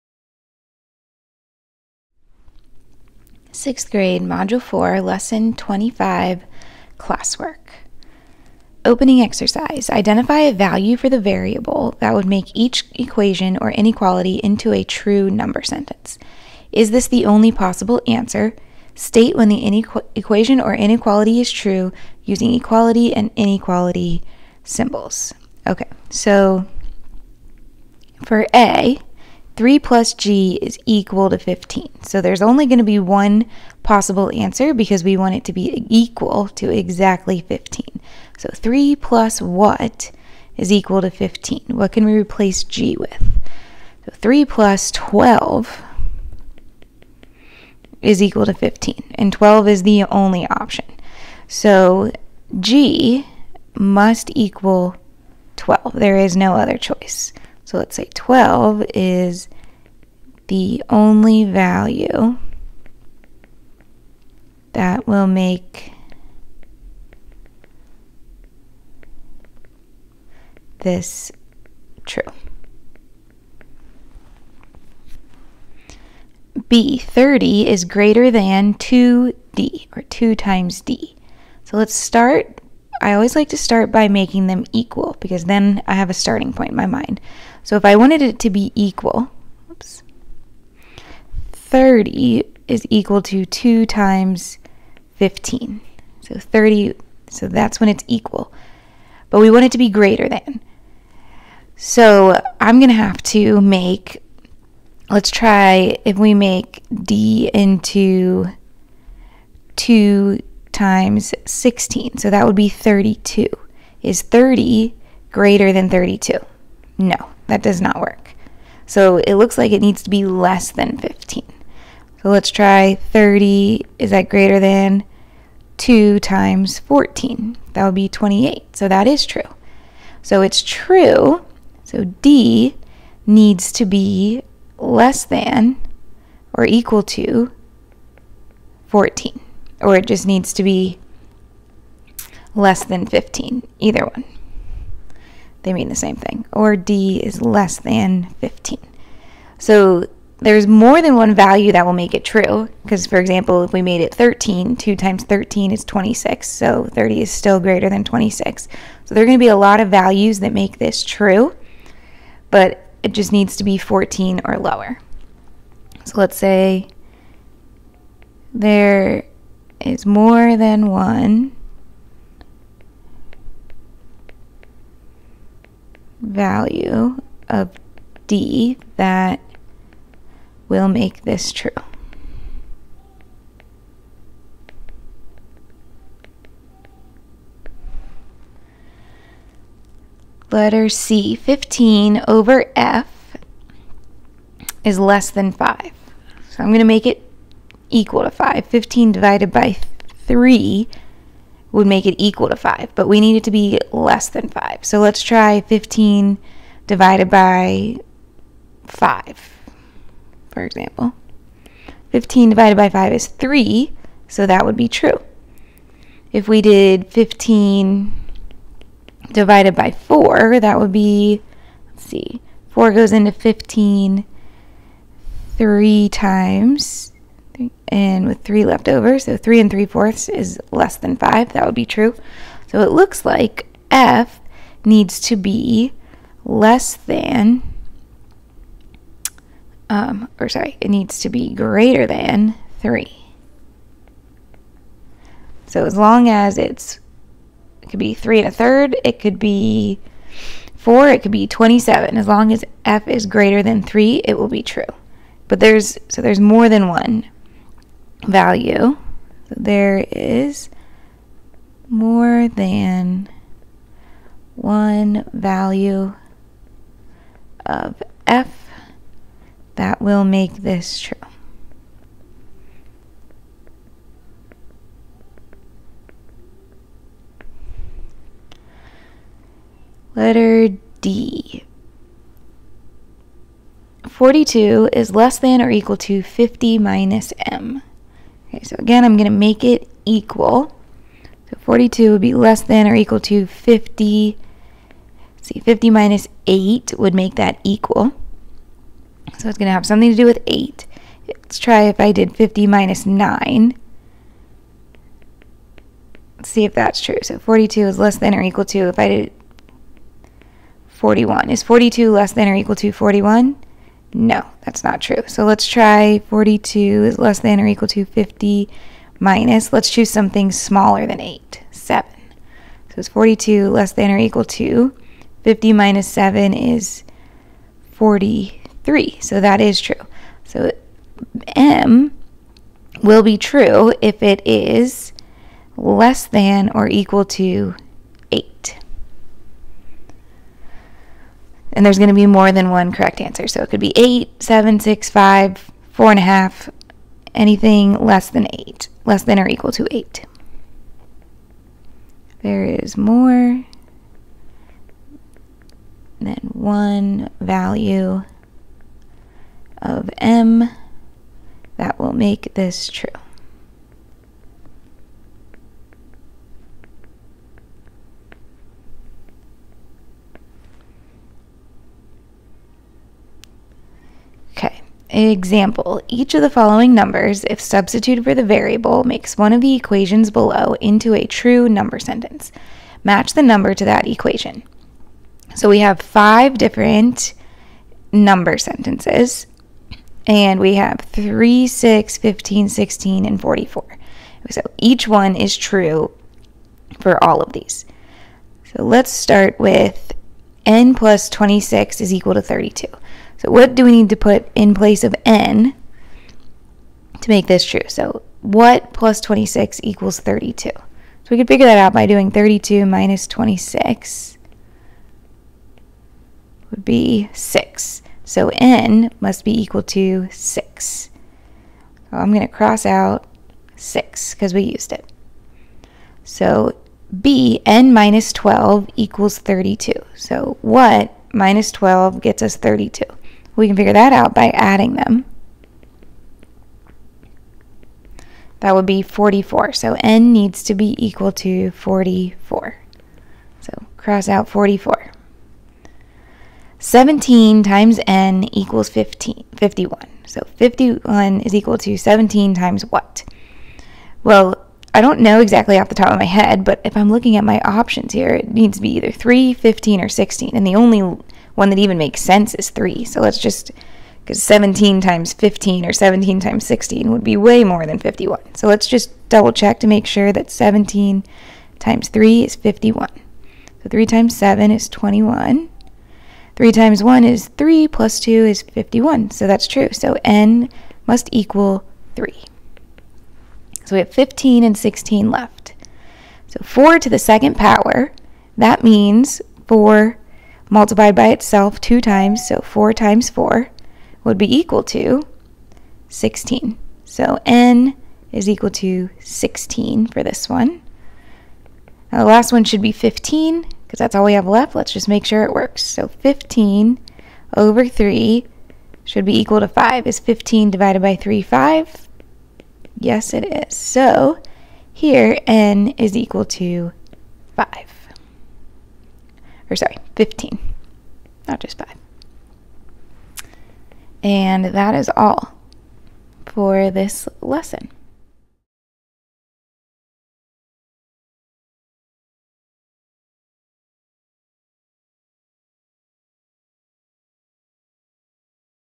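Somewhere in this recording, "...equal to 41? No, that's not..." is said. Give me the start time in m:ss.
5:12.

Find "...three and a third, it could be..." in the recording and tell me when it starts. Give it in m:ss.
4:08.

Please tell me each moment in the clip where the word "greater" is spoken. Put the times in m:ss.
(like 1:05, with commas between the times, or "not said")
1:17, 1:39, 1:55, 2:04, 2:37, 4:01, 4:13.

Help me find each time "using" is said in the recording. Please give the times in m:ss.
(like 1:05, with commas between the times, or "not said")
0:22.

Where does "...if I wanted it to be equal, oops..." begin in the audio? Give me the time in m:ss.
1:27.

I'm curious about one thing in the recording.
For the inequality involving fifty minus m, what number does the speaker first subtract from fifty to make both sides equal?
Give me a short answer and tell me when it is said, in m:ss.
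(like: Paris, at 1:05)
8, at 4:55.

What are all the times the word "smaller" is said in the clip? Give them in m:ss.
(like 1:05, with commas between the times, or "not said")
5:20.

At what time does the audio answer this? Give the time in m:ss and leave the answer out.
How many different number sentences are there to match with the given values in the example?
6:26.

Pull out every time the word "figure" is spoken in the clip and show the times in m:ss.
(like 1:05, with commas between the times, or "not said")
6:51, 7:13.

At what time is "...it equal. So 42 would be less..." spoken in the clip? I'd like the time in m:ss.
4:49.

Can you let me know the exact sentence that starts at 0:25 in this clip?
Okay, so for A, 3 plus g is equal to 15.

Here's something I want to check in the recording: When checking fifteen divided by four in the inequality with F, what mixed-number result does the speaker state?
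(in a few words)
three and three fourths.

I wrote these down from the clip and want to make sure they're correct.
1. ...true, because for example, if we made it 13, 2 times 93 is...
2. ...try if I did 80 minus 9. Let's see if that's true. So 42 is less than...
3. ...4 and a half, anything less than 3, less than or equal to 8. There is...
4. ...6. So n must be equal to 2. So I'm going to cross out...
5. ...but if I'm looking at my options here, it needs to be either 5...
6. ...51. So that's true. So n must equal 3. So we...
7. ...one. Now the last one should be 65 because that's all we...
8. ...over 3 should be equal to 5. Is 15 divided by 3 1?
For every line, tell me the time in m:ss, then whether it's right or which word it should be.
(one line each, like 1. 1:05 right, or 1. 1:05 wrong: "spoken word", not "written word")
1. 2:32 wrong: "13", not "93"
2. 5:01 wrong: "50", not "80"
3. 5:45 wrong: "8", not "3"
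4. 6:57 wrong: "6", not "2"
5. 7:36 wrong: "3", not "5"
6. 7:58 right
7. 8:20 wrong: "15", not "65"
8. 8:27 wrong: "5", not "1".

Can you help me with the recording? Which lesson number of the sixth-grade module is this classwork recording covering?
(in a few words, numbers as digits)
25.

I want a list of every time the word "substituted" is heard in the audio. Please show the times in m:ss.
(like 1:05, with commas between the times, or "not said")
6:17.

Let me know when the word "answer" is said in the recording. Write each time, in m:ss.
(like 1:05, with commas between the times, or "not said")
0:18, 0:34, 5:43.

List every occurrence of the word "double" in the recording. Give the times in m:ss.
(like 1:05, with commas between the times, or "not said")
7:49.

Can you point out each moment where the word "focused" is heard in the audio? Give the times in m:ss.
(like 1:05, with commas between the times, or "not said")
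not said.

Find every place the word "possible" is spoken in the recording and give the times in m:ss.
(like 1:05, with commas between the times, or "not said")
0:17, 0:33.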